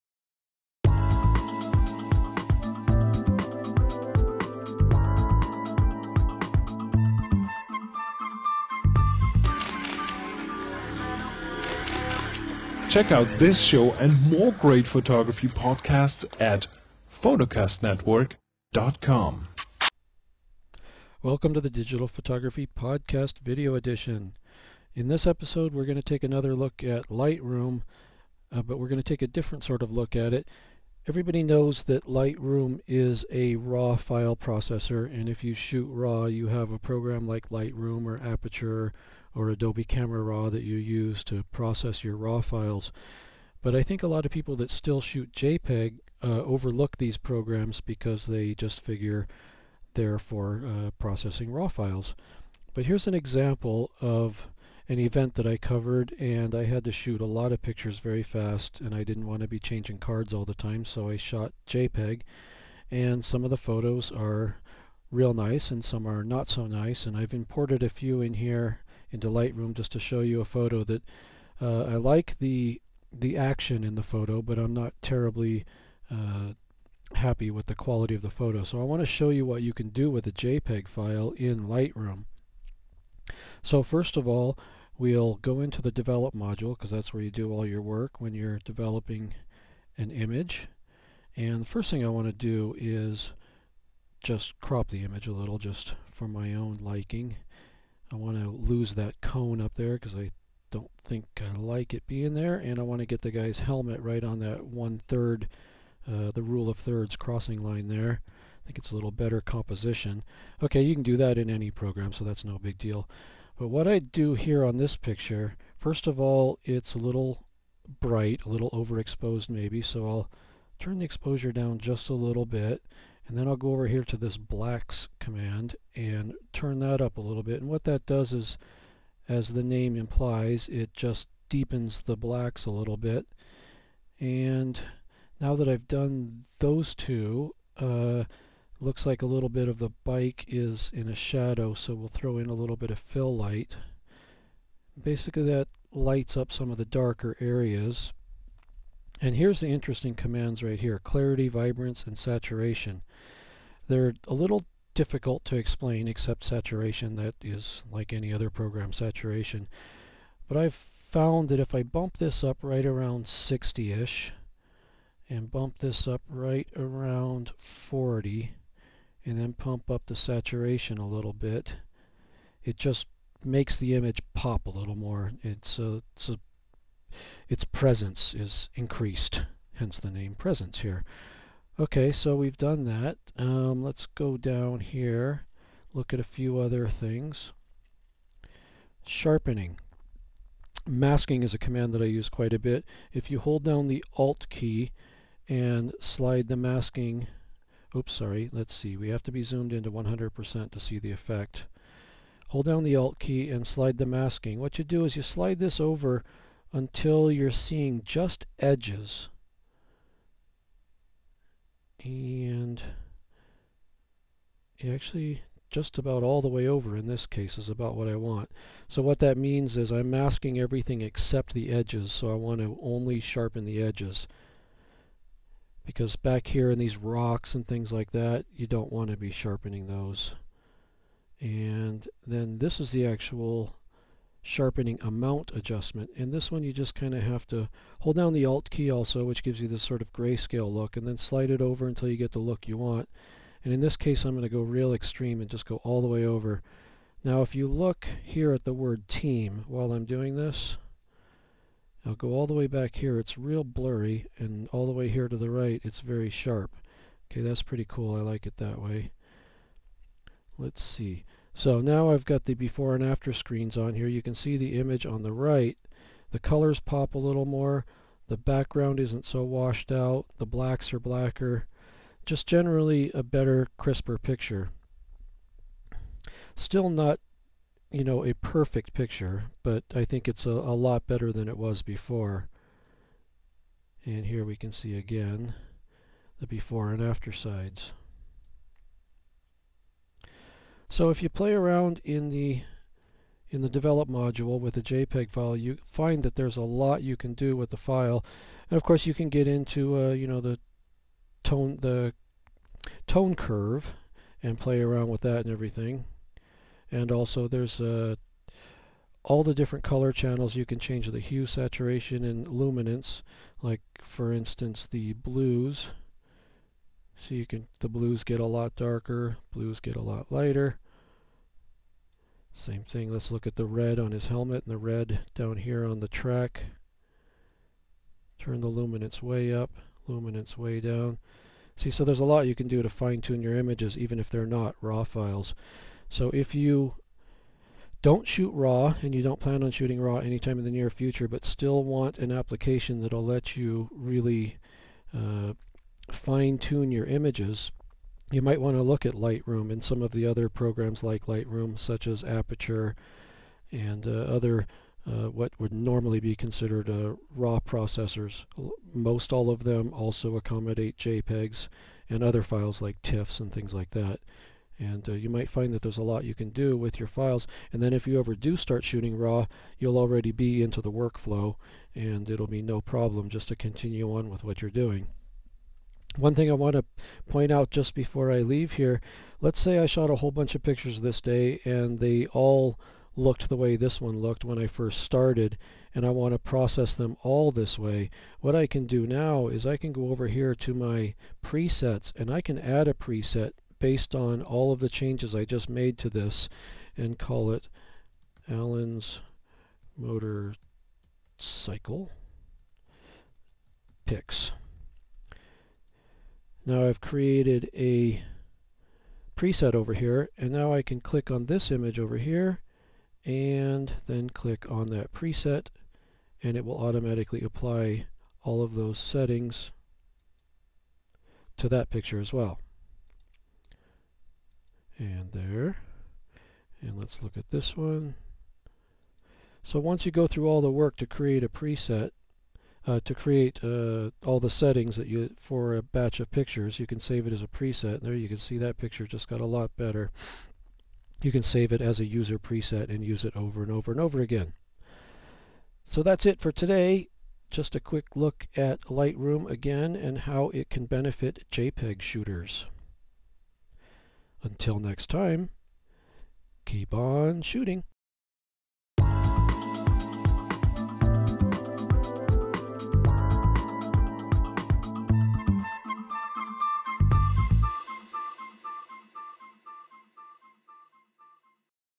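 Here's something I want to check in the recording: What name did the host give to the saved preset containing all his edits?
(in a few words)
Allen's Motor Cycle Picks.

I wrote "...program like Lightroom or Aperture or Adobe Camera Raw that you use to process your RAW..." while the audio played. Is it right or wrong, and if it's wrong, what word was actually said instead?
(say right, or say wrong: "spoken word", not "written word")
right.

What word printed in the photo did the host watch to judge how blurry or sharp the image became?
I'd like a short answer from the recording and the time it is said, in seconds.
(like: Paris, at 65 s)
team, at 249 s.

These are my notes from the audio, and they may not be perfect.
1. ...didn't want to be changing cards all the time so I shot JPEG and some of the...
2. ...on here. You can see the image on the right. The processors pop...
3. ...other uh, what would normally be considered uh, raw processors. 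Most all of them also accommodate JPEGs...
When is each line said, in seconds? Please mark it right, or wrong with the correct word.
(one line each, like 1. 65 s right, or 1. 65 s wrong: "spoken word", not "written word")
1. 59 s right
2. 263 s wrong: "colors", not "processors"
3. 354 s right.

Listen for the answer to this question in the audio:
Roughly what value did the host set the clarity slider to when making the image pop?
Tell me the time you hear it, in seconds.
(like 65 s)
163 s.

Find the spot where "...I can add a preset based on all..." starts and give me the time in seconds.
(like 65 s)
392 s.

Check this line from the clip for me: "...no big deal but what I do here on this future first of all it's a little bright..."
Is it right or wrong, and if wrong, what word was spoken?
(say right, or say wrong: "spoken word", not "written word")
wrong: "picture", not "future".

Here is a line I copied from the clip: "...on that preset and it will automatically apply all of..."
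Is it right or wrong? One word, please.
right.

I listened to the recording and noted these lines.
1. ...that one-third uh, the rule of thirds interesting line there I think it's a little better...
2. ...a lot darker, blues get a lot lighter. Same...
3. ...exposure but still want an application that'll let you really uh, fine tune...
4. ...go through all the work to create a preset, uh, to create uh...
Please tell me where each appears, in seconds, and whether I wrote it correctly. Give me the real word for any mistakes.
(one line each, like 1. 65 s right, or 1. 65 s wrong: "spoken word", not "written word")
1. 104 s wrong: "crossing", not "interesting"
2. 318 s right
3. 340 s wrong: "future", not "exposure"
4. 430 s right.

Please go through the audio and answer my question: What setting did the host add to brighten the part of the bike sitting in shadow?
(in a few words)
fill light.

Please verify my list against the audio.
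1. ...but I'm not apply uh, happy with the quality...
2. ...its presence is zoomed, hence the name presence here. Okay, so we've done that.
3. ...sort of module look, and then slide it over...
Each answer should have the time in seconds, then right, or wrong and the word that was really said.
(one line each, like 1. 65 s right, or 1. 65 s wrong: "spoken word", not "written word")
1. 74 s wrong: "terribly", not "apply"
2. 177 s wrong: "increased", not "zoomed"
3. 239 s wrong: "grayscale", not "module".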